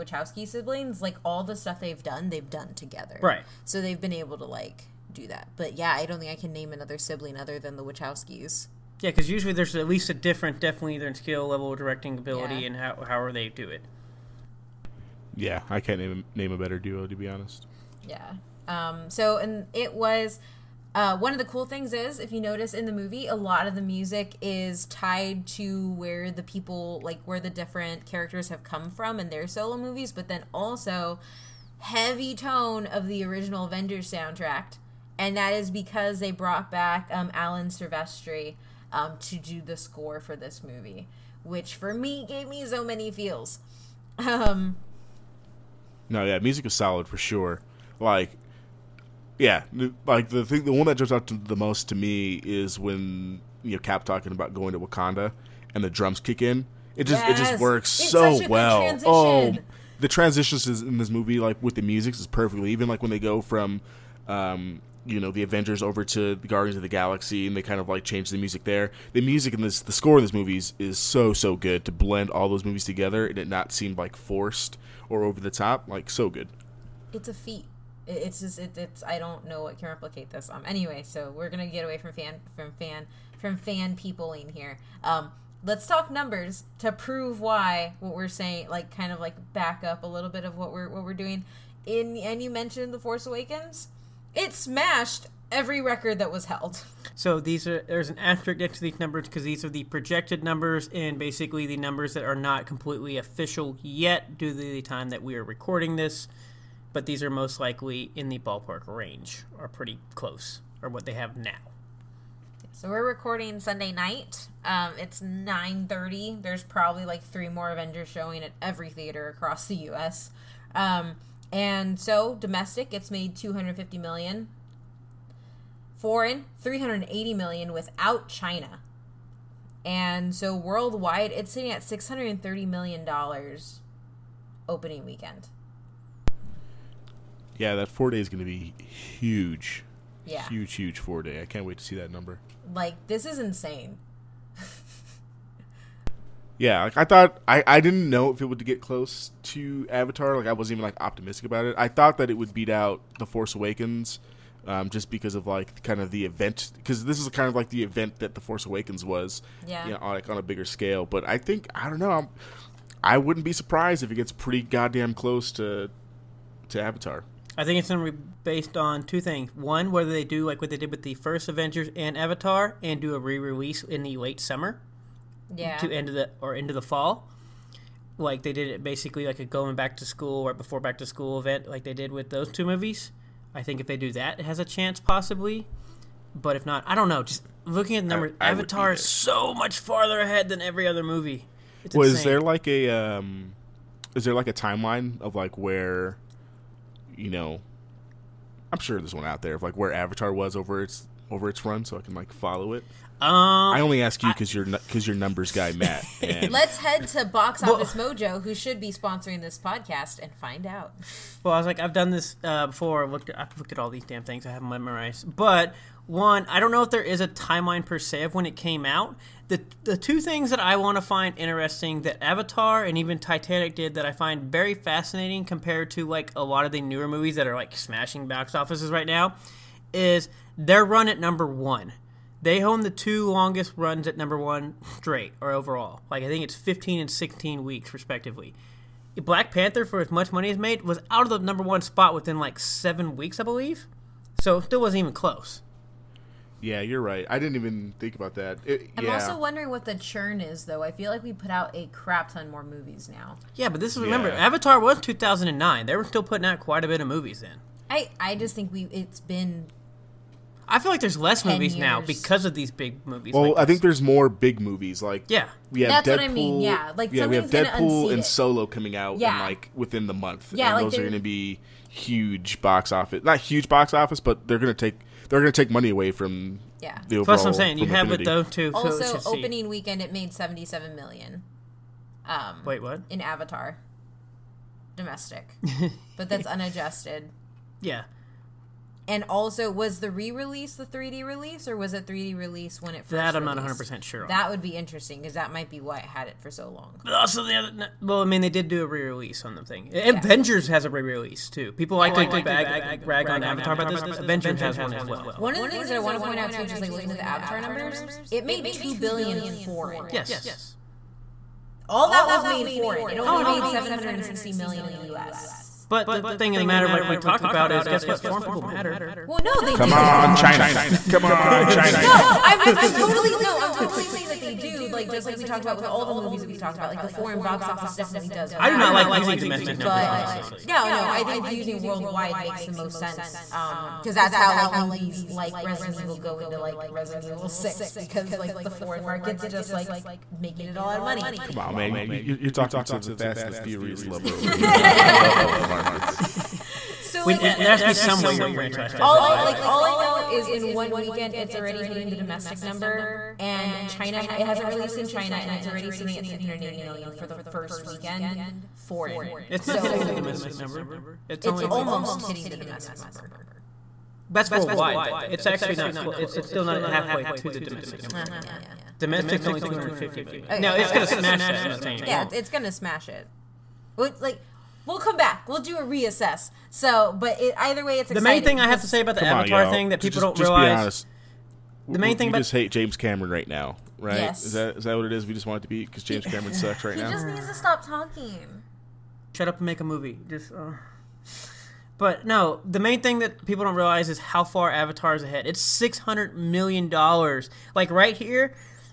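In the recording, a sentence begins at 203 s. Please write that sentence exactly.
Um, I only ask you because you're because you're numbers guy, Matt.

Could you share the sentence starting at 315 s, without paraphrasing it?
But the thing of the matter, like we talk about, is guess what?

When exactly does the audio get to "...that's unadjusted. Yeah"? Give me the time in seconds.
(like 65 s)
286 s.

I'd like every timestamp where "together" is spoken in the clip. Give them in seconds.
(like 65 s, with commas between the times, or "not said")
2 s, 72 s.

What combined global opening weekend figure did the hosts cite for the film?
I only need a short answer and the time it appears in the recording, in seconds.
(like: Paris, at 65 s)
630 million dollars, at 131 s.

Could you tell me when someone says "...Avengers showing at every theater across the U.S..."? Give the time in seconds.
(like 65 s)
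117 s.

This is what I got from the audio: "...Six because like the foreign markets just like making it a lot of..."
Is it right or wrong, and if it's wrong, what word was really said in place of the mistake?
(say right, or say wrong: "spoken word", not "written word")
right.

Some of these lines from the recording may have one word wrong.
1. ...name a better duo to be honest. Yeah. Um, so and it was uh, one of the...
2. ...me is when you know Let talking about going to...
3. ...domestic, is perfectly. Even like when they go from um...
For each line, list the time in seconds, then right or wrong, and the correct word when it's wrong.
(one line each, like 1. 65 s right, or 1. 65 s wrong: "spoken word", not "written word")
1. 16 s right
2. 51 s wrong: "Cap", not "Let"
3. 61 s wrong: "music", not "domestic".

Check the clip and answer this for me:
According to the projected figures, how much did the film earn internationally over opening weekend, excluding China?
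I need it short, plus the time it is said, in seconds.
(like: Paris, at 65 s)
380 million, at 125 s.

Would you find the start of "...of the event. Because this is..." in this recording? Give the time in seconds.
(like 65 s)
156 s.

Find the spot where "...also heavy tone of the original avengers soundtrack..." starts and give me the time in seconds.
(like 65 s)
30 s.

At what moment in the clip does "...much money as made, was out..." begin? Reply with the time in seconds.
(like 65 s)
240 s.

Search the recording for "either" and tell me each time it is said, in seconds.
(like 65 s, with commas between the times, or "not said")
10 s, 377 s.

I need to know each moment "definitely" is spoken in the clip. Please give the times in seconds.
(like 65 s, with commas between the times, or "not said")
10 s, 327 s.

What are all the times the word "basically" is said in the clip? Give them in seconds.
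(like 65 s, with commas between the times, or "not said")
101 s, 178 s.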